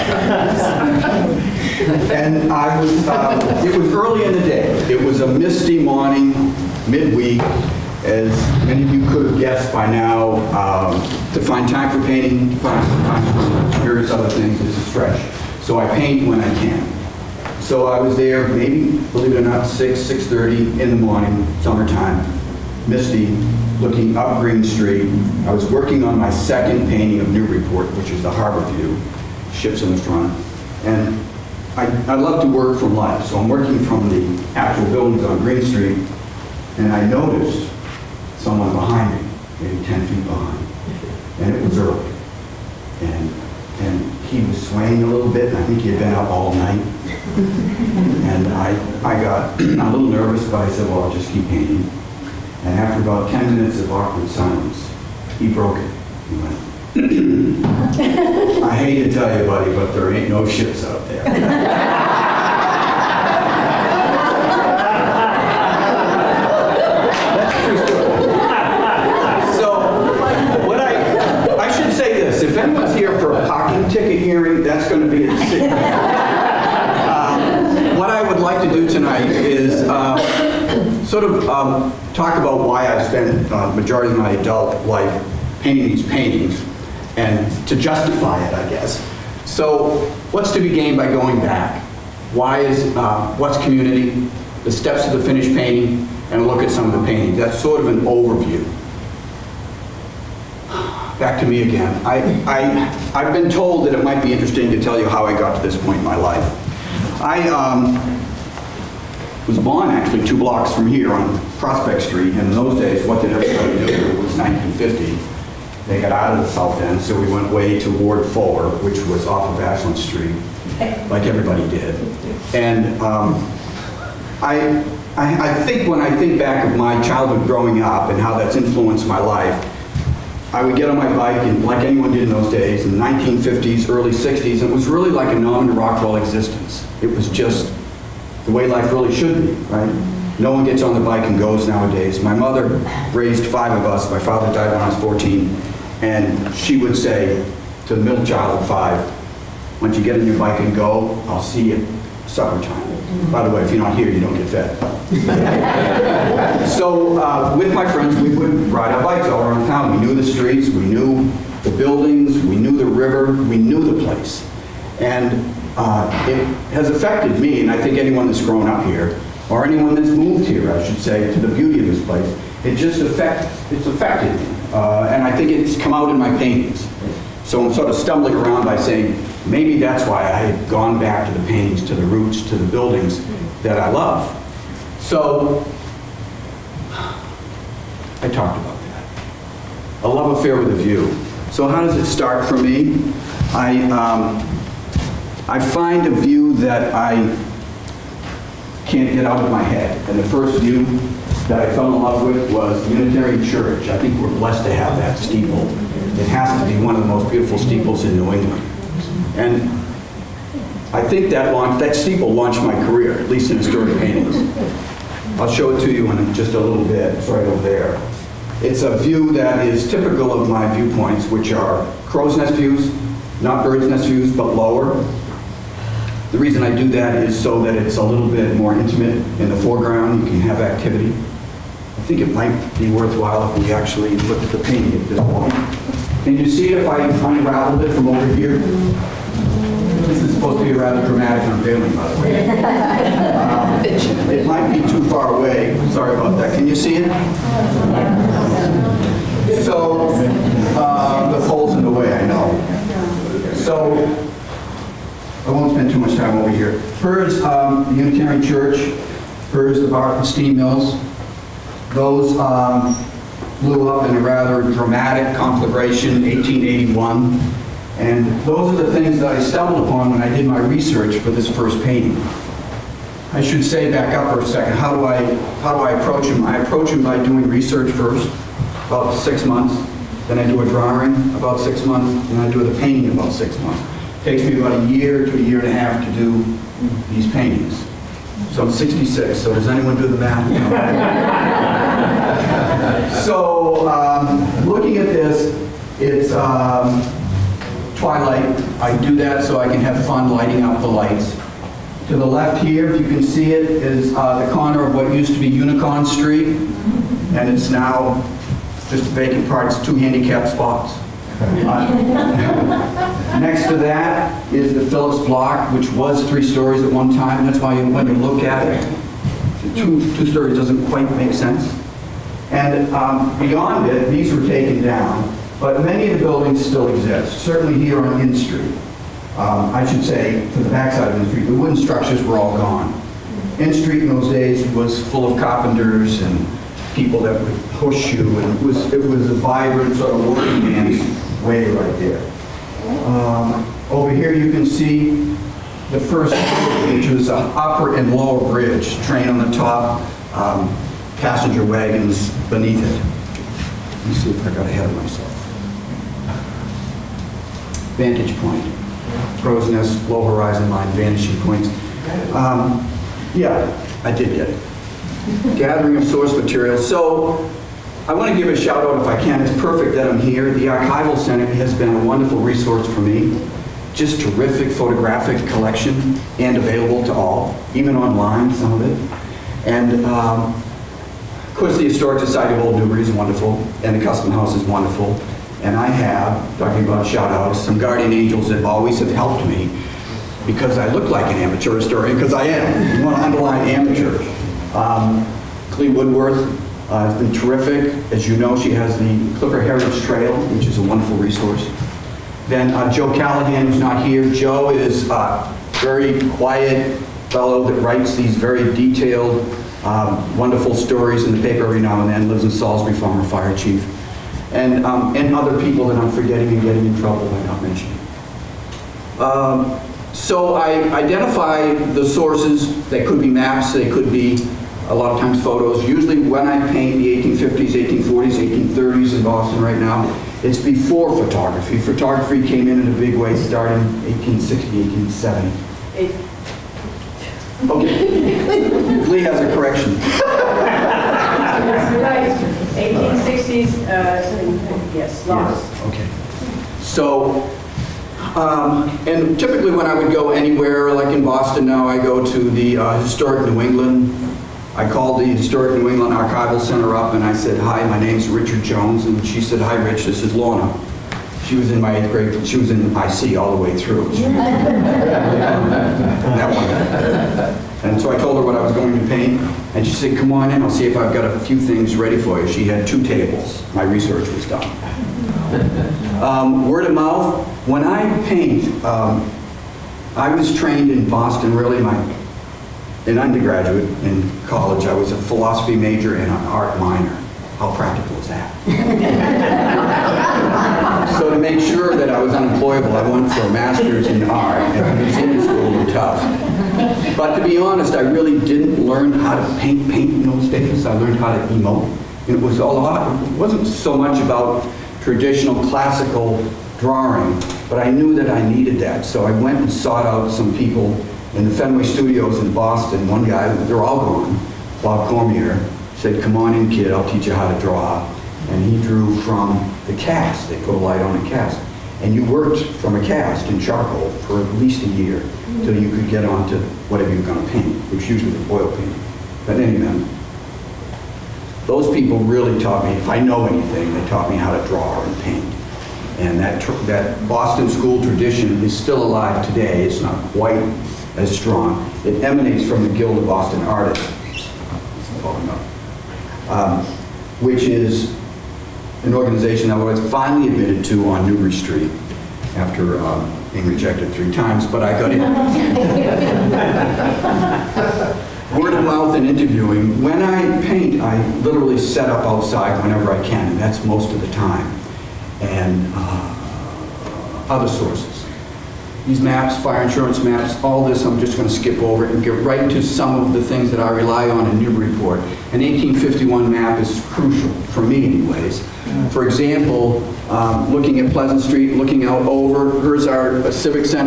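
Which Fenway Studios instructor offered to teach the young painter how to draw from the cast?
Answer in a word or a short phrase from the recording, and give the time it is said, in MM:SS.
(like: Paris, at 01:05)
Bob Cormier, at 08:34.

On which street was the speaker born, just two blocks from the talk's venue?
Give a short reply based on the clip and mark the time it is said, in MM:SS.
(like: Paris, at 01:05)
Prospect Street, at 01:51.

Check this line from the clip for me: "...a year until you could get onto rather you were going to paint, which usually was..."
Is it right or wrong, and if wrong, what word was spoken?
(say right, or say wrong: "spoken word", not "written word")
wrong: "whatever", not "rather".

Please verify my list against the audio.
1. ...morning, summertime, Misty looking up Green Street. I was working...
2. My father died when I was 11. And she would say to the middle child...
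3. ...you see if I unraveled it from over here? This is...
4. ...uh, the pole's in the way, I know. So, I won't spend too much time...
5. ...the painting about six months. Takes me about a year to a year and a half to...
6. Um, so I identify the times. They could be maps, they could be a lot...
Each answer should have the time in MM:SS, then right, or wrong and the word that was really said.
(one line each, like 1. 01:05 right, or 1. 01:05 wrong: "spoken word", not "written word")
1. 00:20 right
2. 02:24 wrong: "14", not "11"
3. 03:56 right
4. 04:10 right
5. 04:42 right
6. 06:59 wrong: "sources", not "times".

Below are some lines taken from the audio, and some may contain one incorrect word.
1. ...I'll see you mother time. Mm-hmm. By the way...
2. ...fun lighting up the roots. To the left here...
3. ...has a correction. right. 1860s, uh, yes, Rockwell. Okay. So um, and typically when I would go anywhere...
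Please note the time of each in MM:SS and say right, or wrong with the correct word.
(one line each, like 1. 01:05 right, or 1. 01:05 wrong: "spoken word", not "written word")
1. 02:31 wrong: "supper", not "mother"
2. 05:00 wrong: "lights", not "roots"
3. 07:19 wrong: "Yes", not "Rockwell".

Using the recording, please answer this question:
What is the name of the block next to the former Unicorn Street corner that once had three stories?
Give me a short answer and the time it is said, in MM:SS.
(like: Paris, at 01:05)
Phillips block, at 05:14.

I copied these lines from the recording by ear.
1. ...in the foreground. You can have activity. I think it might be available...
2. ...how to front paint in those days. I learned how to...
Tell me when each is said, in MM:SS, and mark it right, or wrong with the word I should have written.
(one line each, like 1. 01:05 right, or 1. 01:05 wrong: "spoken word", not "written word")
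1. 03:49 wrong: "worthwhile", not "available"
2. 08:19 wrong: "paint", not "front".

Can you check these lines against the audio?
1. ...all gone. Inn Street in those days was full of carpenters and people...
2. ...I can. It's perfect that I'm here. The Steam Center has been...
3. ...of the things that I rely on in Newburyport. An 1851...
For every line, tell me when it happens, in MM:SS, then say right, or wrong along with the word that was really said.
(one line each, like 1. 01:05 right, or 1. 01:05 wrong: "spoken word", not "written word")
1. 05:32 right
2. 06:09 wrong: "Archival", not "Steam"
3. 09:33 right.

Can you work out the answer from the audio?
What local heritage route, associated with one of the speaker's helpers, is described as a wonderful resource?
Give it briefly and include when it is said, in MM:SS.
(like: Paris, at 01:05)
Clipper Heritage Trail, at 06:39.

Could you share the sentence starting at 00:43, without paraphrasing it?
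And, and he was swaying a little bit, and I think he had been up all night.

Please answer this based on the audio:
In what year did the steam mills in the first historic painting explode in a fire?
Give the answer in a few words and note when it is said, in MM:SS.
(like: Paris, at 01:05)
1881, at 04:26.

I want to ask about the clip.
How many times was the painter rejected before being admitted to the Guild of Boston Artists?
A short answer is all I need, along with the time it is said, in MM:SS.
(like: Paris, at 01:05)
3, at 09:14.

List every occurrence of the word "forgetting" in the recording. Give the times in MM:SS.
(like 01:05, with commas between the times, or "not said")
06:56.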